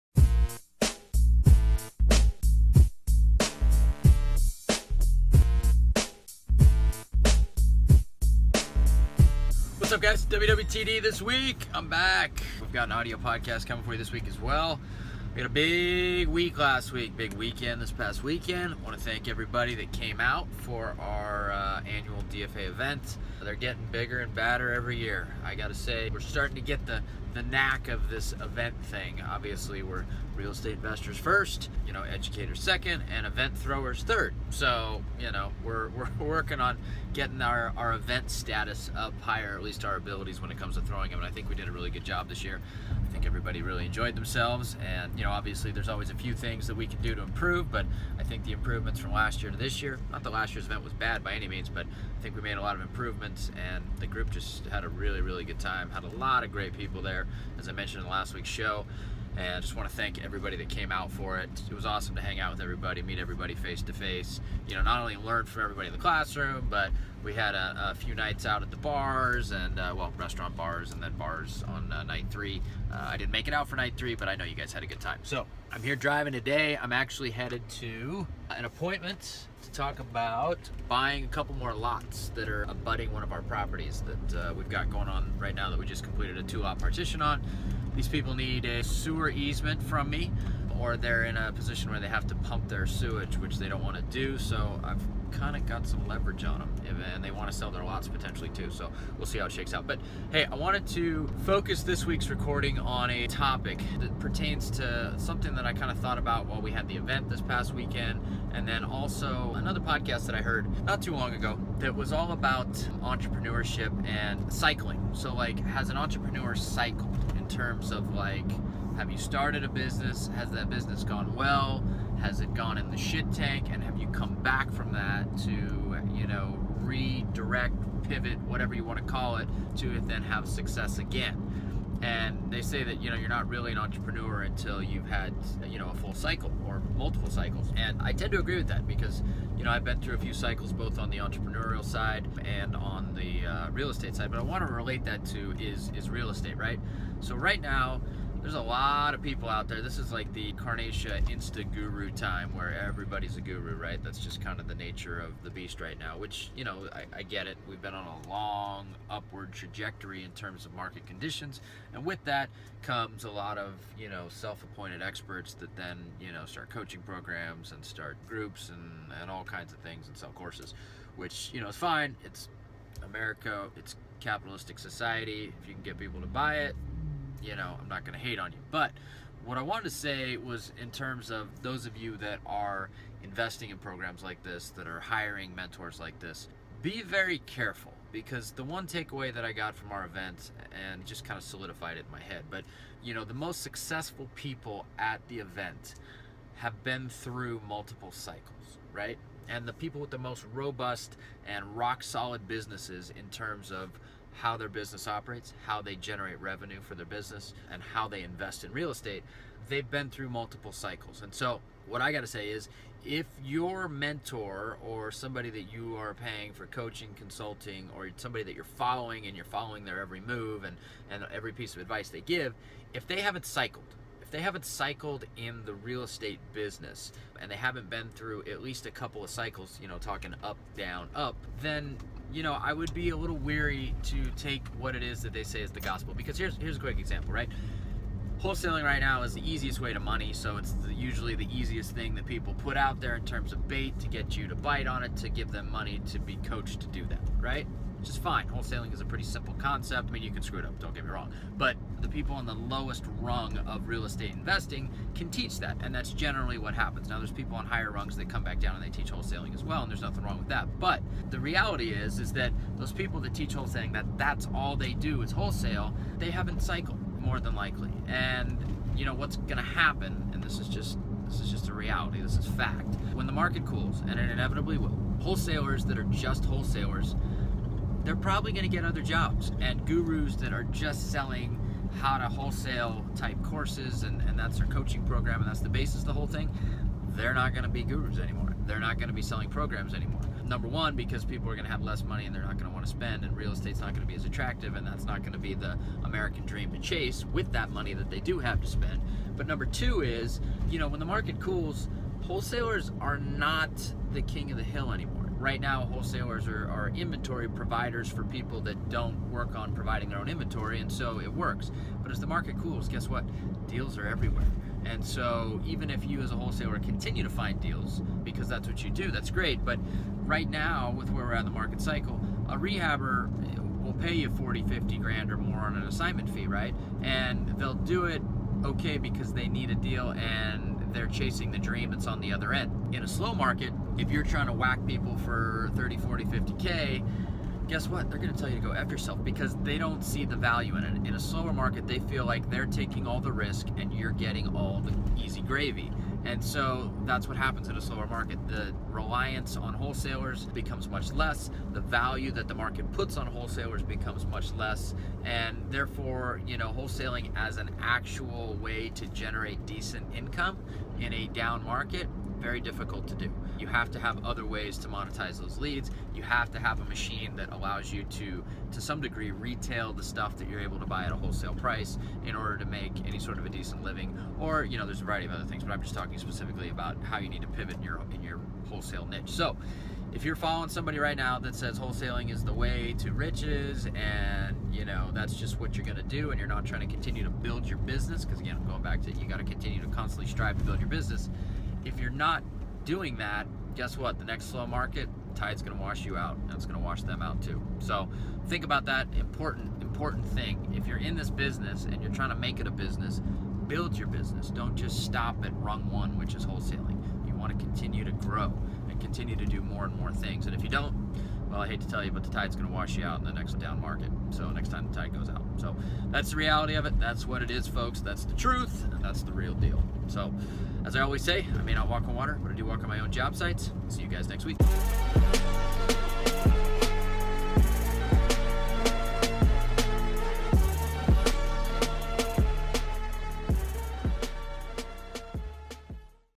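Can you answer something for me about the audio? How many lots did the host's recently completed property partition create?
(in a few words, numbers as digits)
2.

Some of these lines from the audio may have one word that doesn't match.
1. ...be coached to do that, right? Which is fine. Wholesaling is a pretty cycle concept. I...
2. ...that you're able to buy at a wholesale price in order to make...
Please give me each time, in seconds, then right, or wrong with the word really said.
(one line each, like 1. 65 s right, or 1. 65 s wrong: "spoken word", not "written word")
1. 246 s wrong: "simple", not "cycle"
2. 370 s right.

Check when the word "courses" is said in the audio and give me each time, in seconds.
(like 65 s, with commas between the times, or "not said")
170 s, 283 s.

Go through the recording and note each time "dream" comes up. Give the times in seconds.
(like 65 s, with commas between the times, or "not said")
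296 s, 331 s.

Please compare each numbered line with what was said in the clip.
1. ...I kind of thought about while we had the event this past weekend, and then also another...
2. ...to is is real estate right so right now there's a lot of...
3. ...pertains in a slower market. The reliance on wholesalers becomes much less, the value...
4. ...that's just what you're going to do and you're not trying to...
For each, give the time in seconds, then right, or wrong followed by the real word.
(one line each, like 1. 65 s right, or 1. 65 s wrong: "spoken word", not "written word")
1. 105 s right
2. 145 s right
3. 347 s wrong: "happens", not "pertains"
4. 385 s right.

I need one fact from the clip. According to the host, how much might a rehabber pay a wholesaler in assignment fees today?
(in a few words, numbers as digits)
40, 50 grand.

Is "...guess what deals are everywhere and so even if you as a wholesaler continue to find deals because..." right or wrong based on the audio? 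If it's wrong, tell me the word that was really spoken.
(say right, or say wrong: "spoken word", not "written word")
right.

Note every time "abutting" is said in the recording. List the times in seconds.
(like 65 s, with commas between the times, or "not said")
82 s.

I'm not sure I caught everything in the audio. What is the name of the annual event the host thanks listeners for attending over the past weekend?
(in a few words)
DFA.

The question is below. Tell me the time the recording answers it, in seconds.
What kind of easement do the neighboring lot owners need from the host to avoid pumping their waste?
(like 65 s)
88 s.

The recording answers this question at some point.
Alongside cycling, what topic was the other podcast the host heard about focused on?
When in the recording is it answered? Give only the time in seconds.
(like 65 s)
113 s.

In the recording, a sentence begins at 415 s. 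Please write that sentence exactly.
So that's the reality of it.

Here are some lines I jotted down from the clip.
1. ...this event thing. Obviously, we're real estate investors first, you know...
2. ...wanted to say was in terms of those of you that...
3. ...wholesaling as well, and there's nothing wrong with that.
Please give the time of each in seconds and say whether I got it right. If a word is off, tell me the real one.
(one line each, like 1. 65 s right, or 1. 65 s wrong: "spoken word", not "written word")
1. 28 s right
2. 179 s right
3. 259 s right.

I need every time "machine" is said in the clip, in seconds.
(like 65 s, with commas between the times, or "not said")
366 s.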